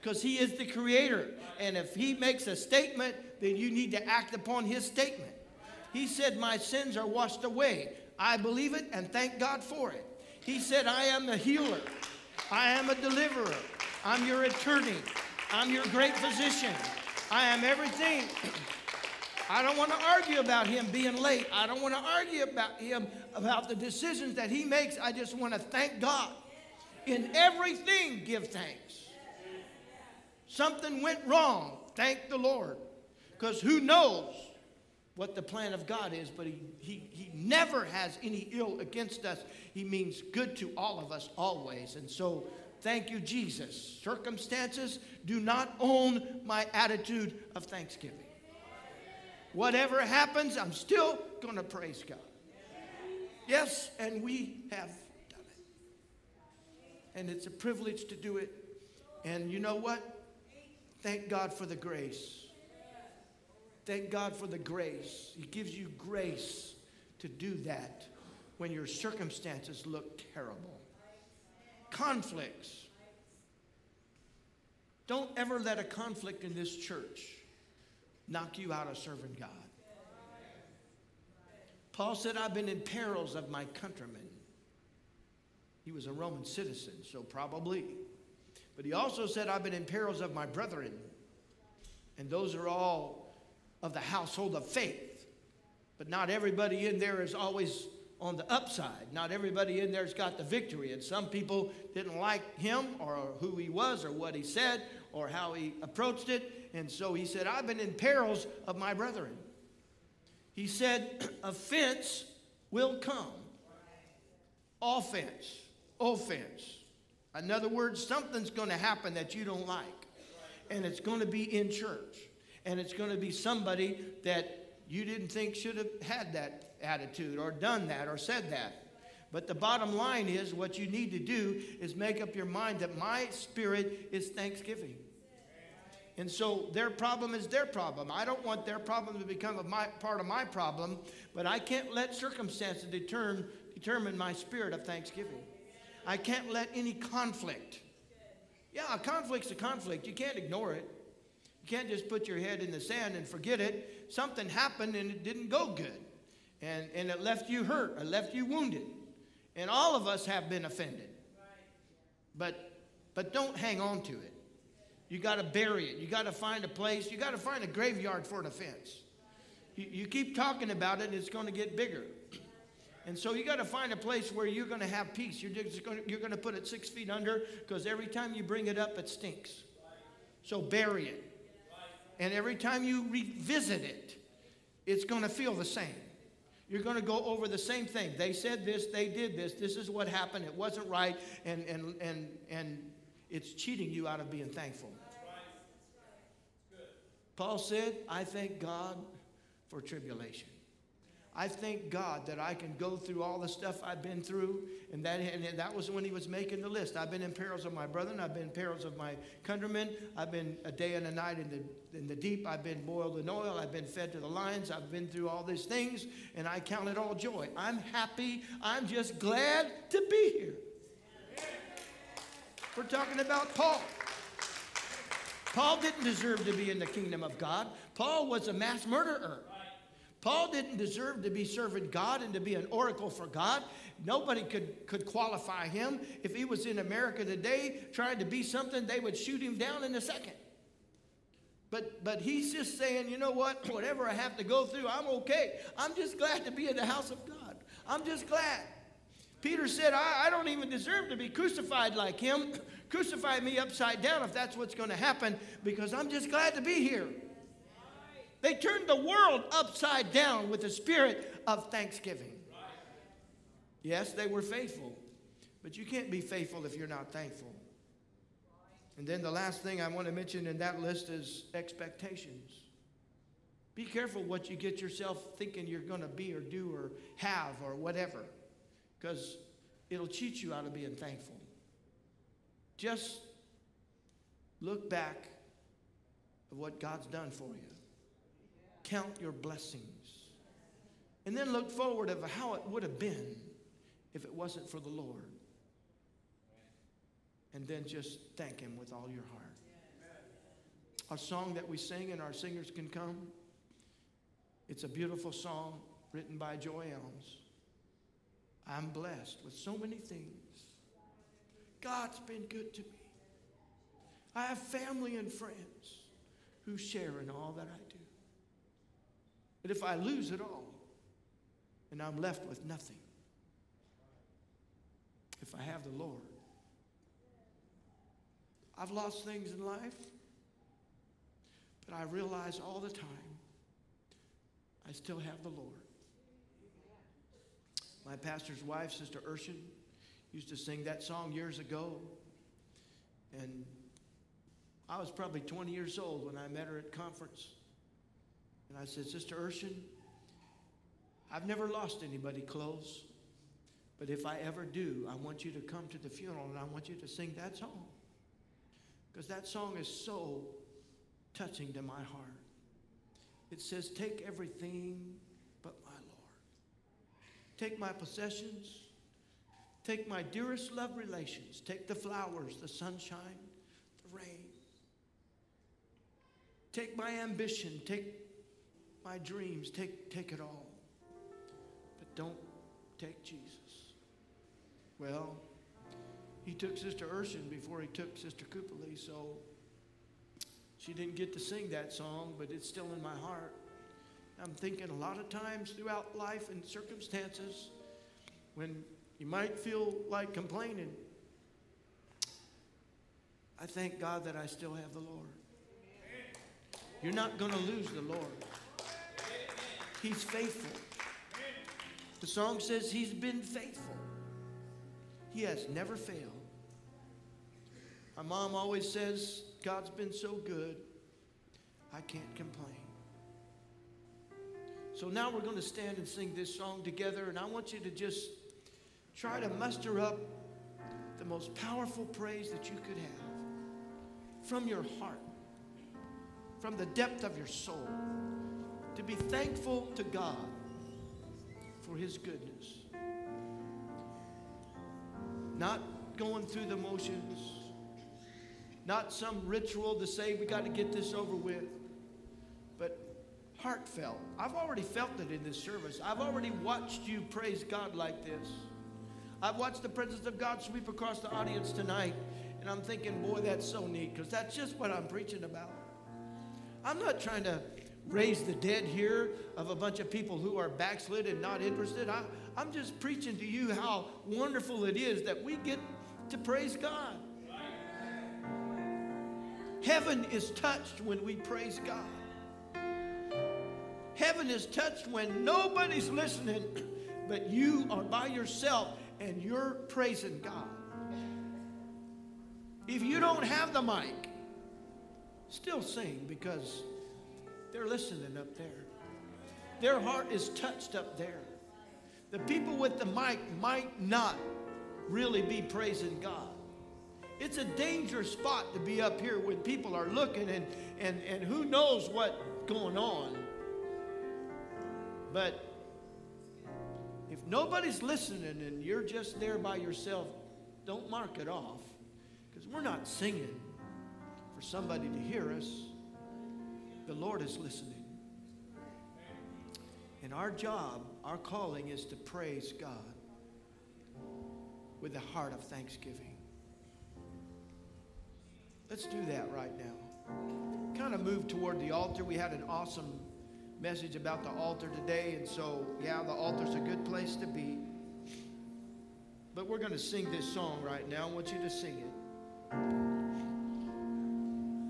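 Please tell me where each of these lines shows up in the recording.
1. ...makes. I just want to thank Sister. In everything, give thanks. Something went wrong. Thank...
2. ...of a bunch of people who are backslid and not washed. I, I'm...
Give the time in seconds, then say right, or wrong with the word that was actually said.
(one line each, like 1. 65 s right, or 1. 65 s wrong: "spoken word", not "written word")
1. 24 s wrong: "God", not "Sister"
2. 469 s wrong: "interested", not "washed".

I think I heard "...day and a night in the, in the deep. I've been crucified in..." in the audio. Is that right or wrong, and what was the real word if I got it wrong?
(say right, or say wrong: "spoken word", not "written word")
wrong: "boiled", not "crucified".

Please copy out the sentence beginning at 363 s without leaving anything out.
It says, Take everything but my Lord.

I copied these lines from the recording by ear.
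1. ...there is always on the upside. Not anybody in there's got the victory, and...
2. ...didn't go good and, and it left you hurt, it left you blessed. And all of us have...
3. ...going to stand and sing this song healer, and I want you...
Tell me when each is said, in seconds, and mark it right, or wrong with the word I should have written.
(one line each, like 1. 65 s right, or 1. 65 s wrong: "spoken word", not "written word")
1. 96 s wrong: "everybody", not "anybody"
2. 155 s wrong: "wounded", not "blessed"
3. 425 s wrong: "together", not "healer".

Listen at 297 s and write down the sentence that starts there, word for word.
And then just thank Him with all your heart.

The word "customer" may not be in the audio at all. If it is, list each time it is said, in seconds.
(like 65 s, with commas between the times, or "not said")
not said.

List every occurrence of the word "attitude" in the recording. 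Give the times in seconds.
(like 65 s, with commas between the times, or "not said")
46 s, 126 s.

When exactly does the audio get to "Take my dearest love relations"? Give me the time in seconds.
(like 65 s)
369 s.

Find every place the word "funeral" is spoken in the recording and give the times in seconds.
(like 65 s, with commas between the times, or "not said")
356 s.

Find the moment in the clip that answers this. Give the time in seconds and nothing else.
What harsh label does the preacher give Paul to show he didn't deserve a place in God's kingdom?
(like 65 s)
228 s.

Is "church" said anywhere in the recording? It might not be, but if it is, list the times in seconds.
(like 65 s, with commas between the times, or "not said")
76 s, 121 s.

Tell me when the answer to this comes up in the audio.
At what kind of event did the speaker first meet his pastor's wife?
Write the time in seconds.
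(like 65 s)
346 s.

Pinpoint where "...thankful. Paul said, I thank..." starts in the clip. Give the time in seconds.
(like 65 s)
194 s.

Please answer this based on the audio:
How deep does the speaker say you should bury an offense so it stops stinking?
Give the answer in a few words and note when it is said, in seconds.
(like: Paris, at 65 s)
six feet under, at 176 s.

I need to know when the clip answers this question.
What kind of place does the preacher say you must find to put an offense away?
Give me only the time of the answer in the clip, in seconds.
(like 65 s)
167 s.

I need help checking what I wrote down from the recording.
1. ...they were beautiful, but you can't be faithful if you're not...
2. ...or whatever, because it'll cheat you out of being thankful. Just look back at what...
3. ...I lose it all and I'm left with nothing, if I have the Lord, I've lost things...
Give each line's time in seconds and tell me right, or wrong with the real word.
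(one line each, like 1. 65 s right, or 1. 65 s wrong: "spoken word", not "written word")
1. 264 s wrong: "faithful", not "beautiful"
2. 277 s right
3. 319 s right.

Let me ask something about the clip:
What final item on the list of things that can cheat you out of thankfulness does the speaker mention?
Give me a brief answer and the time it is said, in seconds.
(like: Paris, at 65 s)
expectations, at 271 s.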